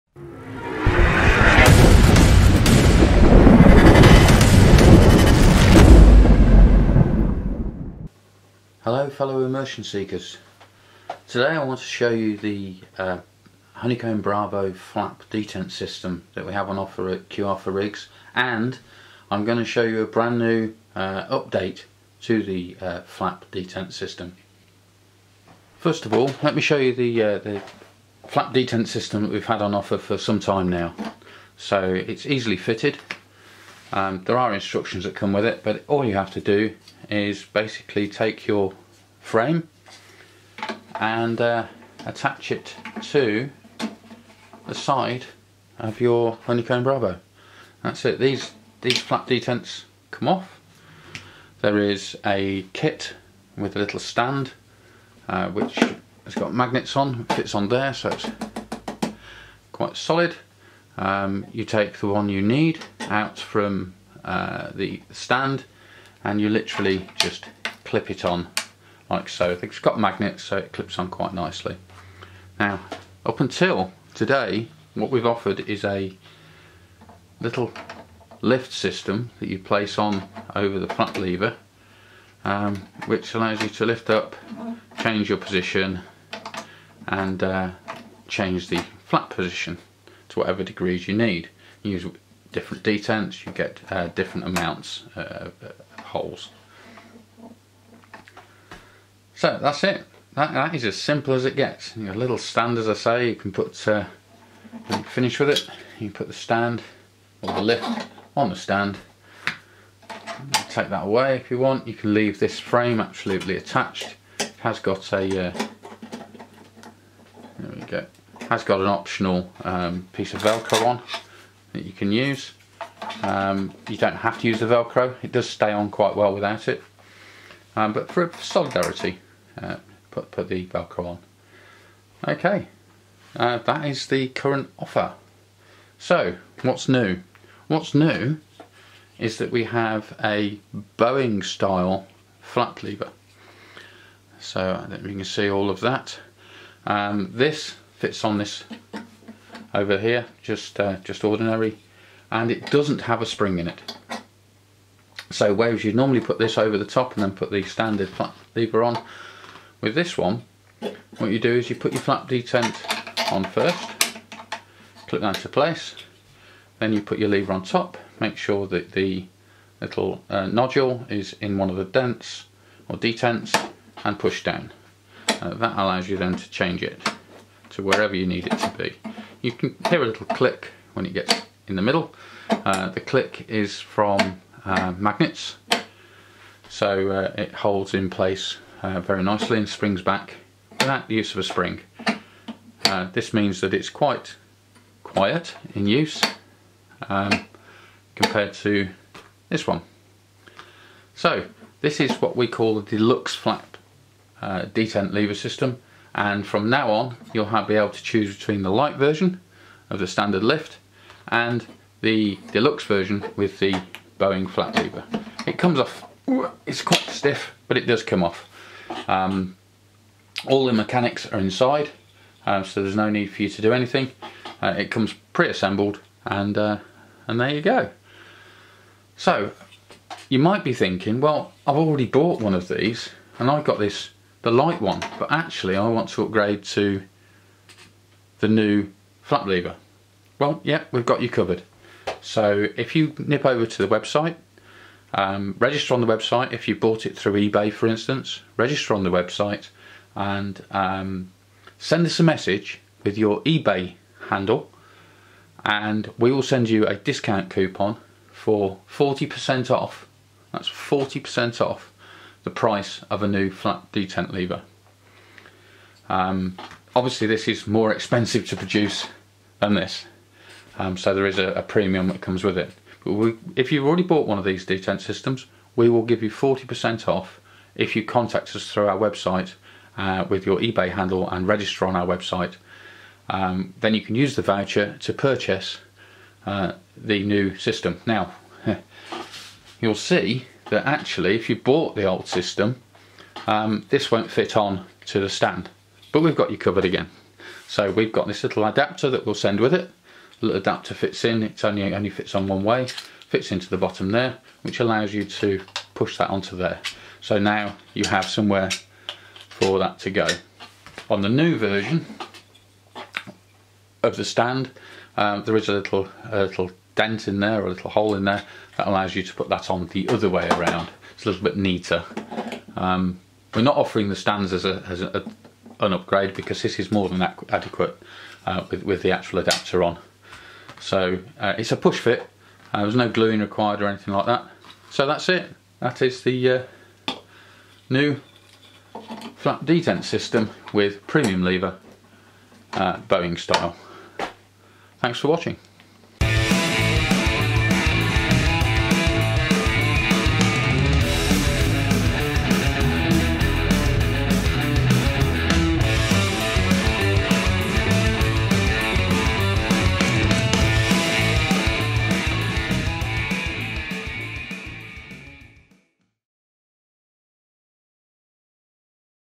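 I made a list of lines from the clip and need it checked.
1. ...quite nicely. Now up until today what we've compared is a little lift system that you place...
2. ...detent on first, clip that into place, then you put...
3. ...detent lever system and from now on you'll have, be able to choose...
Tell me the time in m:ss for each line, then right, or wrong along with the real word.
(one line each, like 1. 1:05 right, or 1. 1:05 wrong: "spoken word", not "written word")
1. 1:11 wrong: "offered", not "compared"
2. 2:42 right
3. 3:24 right.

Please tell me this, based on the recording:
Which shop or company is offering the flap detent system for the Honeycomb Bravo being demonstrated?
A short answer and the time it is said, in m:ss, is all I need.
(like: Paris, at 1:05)
QR4rigs, at 0:17.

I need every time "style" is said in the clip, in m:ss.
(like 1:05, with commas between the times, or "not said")
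2:21, 5:43.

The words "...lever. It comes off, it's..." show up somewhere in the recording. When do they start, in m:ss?
3:34.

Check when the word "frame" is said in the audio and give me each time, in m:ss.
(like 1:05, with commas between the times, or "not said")
0:39, 1:52.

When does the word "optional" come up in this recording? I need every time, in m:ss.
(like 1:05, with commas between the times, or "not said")
1:58.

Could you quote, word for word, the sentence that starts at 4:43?
Um, then you can use the voucher to purchase uh, the new system.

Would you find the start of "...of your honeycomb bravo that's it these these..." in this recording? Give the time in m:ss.
0:45.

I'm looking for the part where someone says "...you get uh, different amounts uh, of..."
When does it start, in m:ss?
1:33.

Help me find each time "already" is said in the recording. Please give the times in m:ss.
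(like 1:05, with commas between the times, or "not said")
3:51, 4:33.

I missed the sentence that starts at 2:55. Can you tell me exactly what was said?
Uh, that allows you then to change it to wherever you need it to be.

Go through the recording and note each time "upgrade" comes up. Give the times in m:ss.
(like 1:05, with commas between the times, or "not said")
3:56, 5:25.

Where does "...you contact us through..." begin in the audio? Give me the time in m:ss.
4:37.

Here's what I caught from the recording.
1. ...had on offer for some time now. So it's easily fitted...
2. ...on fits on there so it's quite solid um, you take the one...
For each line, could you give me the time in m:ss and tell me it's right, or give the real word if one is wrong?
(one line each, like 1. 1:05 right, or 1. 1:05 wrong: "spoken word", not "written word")
1. 0:29 right
2. 0:56 right.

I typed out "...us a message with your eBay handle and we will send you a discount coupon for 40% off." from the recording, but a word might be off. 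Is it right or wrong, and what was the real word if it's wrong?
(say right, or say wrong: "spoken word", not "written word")
right.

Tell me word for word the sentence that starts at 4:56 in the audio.
But we've got you covered again.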